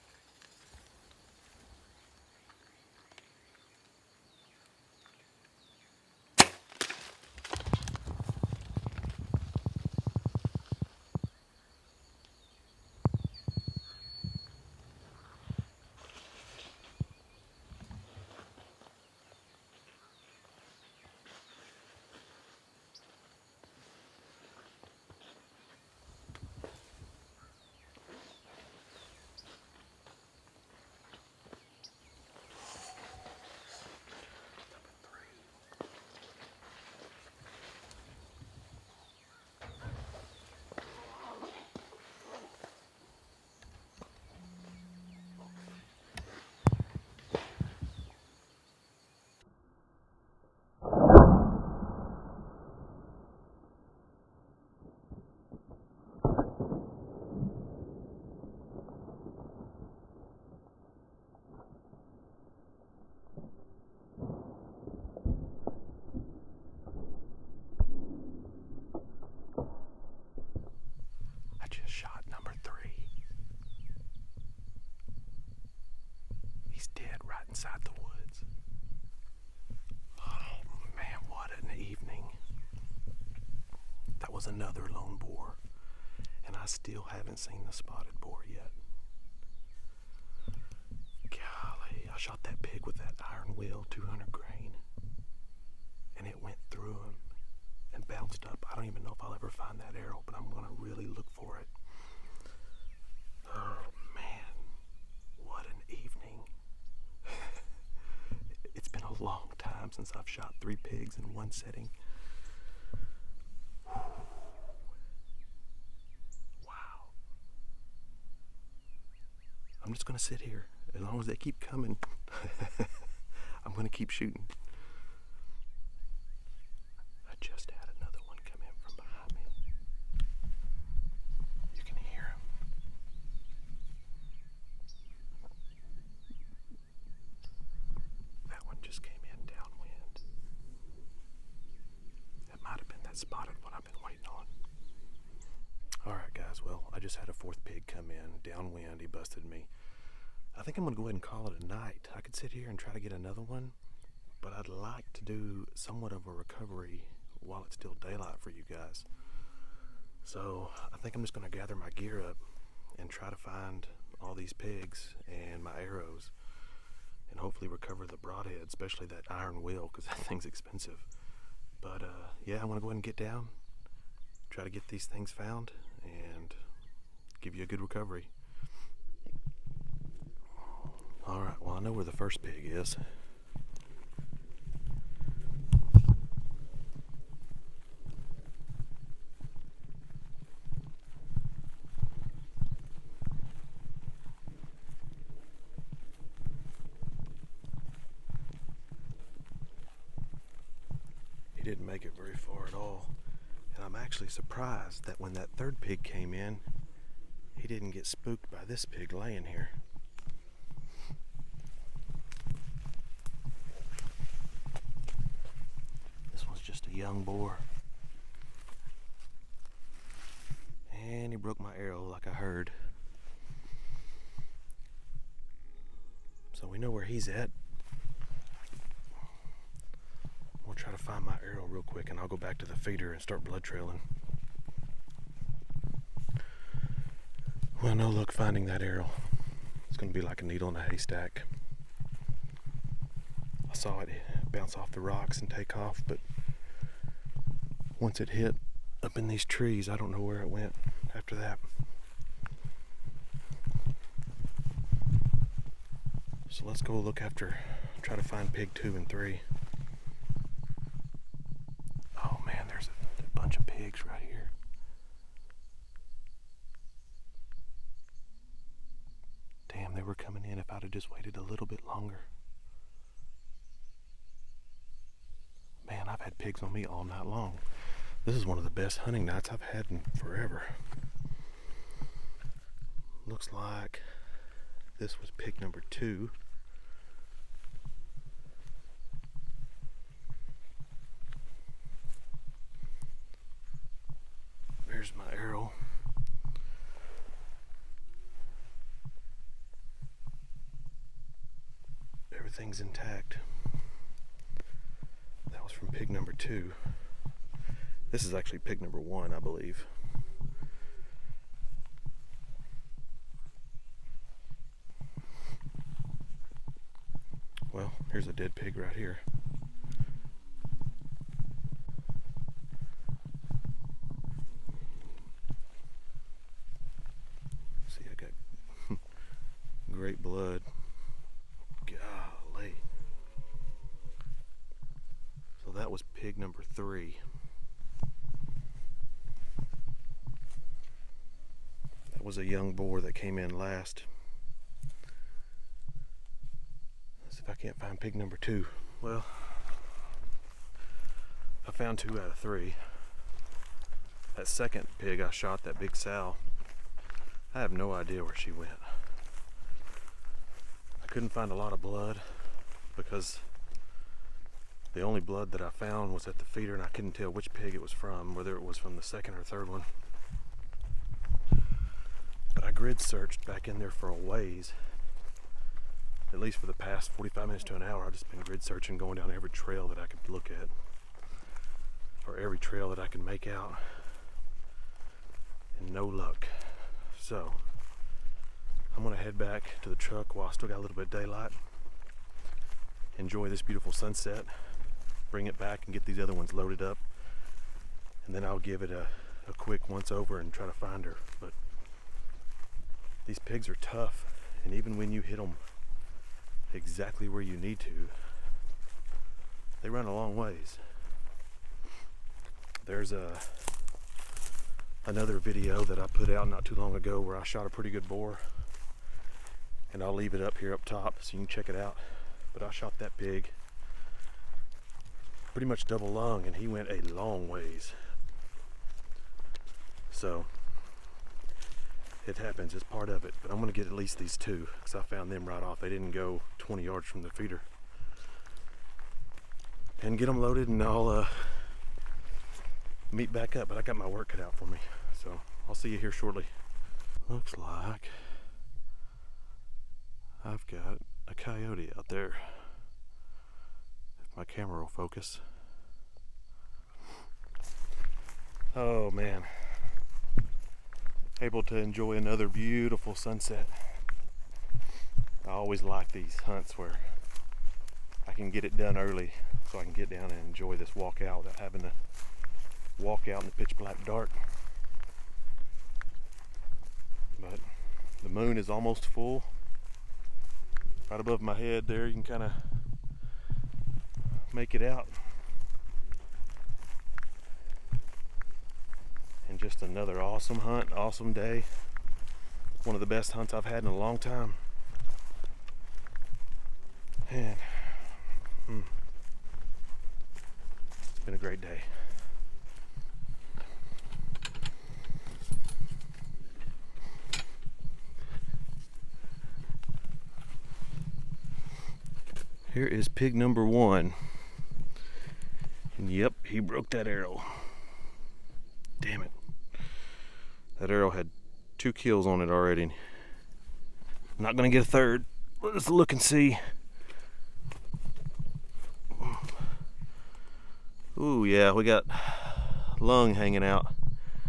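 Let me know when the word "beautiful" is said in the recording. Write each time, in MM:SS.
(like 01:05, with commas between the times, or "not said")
06:33, 07:42.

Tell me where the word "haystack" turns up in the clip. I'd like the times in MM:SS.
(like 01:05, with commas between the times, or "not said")
04:00.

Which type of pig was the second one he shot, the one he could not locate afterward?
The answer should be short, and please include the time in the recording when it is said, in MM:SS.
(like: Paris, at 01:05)
big sow, at 05:55.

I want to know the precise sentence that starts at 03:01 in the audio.
All right, well, I know where the first pig is.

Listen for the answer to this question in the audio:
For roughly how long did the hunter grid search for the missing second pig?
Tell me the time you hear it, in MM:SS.
06:17.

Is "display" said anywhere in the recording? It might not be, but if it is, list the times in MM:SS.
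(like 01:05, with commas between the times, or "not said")
not said.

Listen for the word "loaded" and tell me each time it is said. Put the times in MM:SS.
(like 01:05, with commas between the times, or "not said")
06:36, 07:20.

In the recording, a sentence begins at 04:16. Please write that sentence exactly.
So let's go look after, try to find pig two and three.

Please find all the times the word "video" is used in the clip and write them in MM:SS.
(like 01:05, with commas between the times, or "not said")
06:55.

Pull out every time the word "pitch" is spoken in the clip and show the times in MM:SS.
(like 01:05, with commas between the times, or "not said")
07:53.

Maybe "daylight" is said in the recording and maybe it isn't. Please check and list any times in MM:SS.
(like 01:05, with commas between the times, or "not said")
02:38, 06:31.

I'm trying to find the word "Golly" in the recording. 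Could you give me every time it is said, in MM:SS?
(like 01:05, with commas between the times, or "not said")
01:31, 05:31.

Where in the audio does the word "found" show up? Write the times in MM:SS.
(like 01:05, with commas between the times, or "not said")
02:55, 05:51, 06:05, 07:15.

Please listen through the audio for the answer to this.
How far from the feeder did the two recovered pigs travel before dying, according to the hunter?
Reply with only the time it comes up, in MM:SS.
07:16.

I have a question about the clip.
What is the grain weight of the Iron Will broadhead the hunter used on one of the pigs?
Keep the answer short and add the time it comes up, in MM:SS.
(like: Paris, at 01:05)
200 grain, at 01:33.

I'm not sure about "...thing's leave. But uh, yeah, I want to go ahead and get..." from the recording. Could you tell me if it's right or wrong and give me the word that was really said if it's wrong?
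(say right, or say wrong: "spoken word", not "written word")
wrong: "expensive", not "leave".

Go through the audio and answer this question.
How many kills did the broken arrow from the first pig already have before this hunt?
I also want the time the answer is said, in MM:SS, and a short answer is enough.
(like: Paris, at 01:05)
2, at 08:41.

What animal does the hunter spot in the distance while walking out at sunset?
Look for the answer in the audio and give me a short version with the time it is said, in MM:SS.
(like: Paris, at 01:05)
coyote, at 07:31.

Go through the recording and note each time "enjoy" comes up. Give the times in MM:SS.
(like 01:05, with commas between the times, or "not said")
06:33, 07:41, 07:50.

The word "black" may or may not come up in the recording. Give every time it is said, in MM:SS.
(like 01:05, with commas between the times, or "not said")
07:53.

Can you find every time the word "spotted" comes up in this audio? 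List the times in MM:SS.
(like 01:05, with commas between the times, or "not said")
01:27.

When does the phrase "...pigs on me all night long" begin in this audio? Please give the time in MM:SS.
04:36.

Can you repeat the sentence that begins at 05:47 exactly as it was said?
Let's see if I can't find pig number two.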